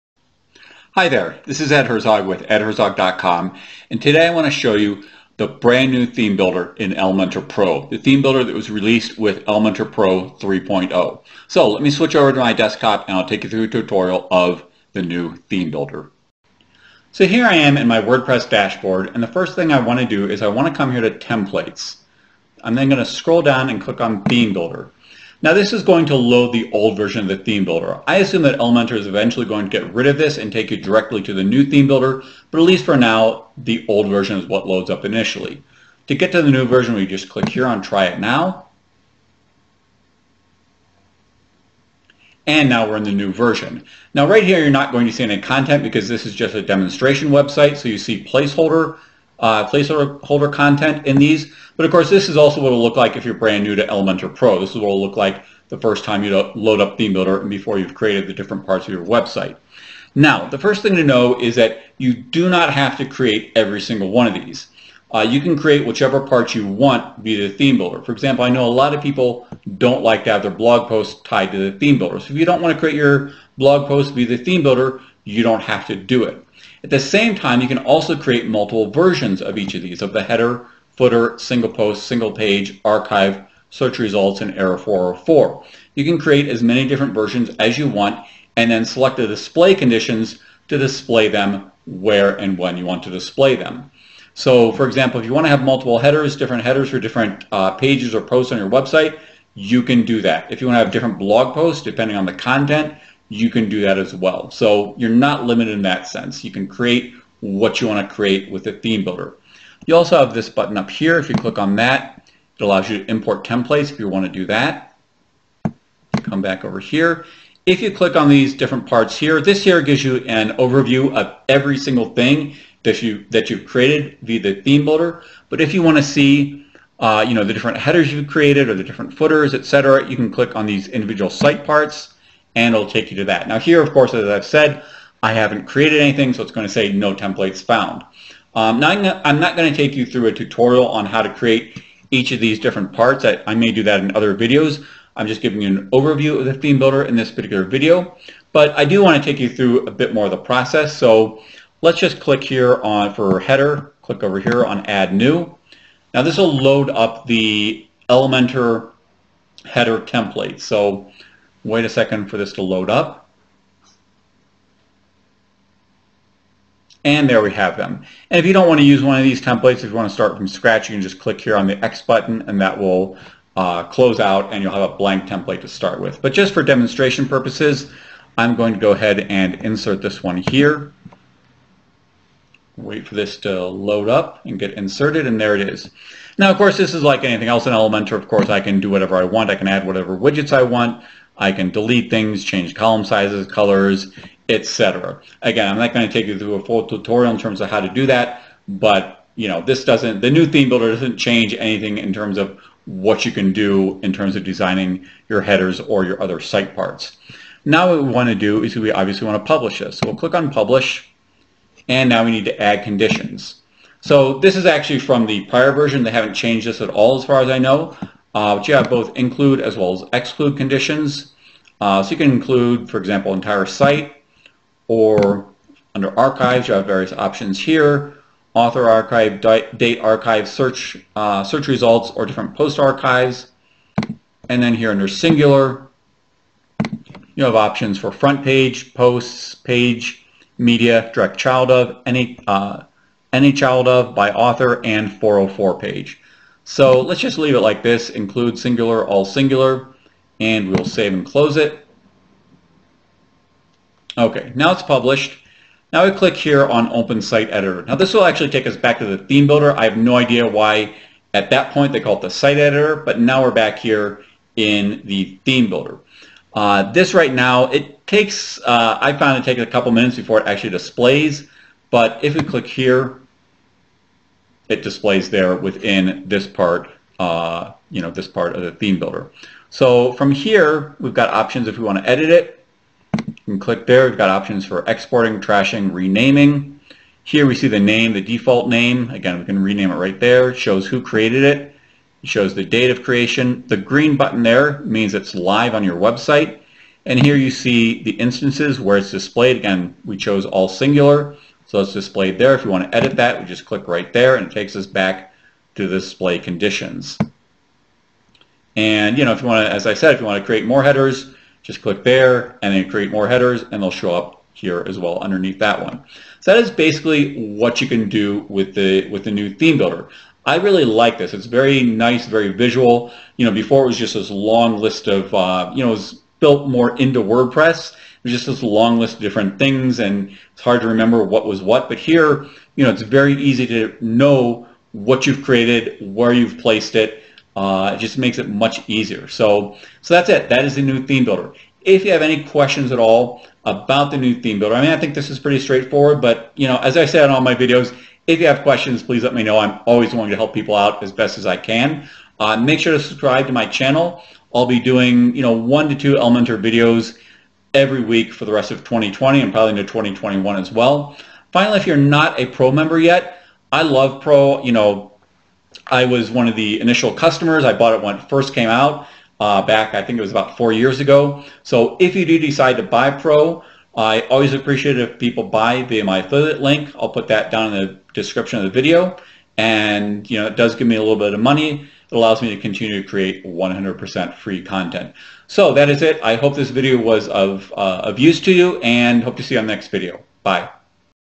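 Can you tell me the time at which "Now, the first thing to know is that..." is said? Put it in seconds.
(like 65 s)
60 s.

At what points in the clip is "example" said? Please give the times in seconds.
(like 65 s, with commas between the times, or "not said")
68 s, 94 s, 222 s.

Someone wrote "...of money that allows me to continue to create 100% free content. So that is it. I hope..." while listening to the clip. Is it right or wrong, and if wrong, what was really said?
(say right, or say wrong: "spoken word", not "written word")
right.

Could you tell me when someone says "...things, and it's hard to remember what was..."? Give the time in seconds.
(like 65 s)
329 s.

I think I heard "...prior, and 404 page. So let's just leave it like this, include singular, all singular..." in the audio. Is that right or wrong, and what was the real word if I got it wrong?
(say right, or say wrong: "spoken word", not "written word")
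wrong: "author", not "prior".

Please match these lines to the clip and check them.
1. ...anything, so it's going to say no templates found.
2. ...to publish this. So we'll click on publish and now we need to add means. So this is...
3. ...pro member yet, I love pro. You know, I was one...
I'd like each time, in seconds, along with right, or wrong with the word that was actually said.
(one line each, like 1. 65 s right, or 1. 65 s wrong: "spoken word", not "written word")
1. 136 s right
2. 209 s wrong: "conditions", not "means"
3. 362 s right.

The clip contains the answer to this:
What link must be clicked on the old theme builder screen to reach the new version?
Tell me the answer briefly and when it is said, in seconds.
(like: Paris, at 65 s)
Try it now, at 37 s.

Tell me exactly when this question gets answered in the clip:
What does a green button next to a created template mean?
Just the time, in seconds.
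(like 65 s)
295 s.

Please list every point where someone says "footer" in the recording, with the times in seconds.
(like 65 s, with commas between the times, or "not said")
80 s, 129 s.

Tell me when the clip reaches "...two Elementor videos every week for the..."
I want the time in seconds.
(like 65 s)
355 s.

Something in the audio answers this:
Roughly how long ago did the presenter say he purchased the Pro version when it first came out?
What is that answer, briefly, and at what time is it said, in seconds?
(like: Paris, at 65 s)
About 4 years, at 370 s.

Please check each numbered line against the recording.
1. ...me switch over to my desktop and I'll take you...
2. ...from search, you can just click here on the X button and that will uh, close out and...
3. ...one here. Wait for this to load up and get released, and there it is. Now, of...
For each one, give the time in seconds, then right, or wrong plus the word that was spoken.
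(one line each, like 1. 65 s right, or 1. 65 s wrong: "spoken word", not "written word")
1. 11 s right
2. 170 s wrong: "scratch", not "search"
3. 180 s wrong: "inserted", not "released".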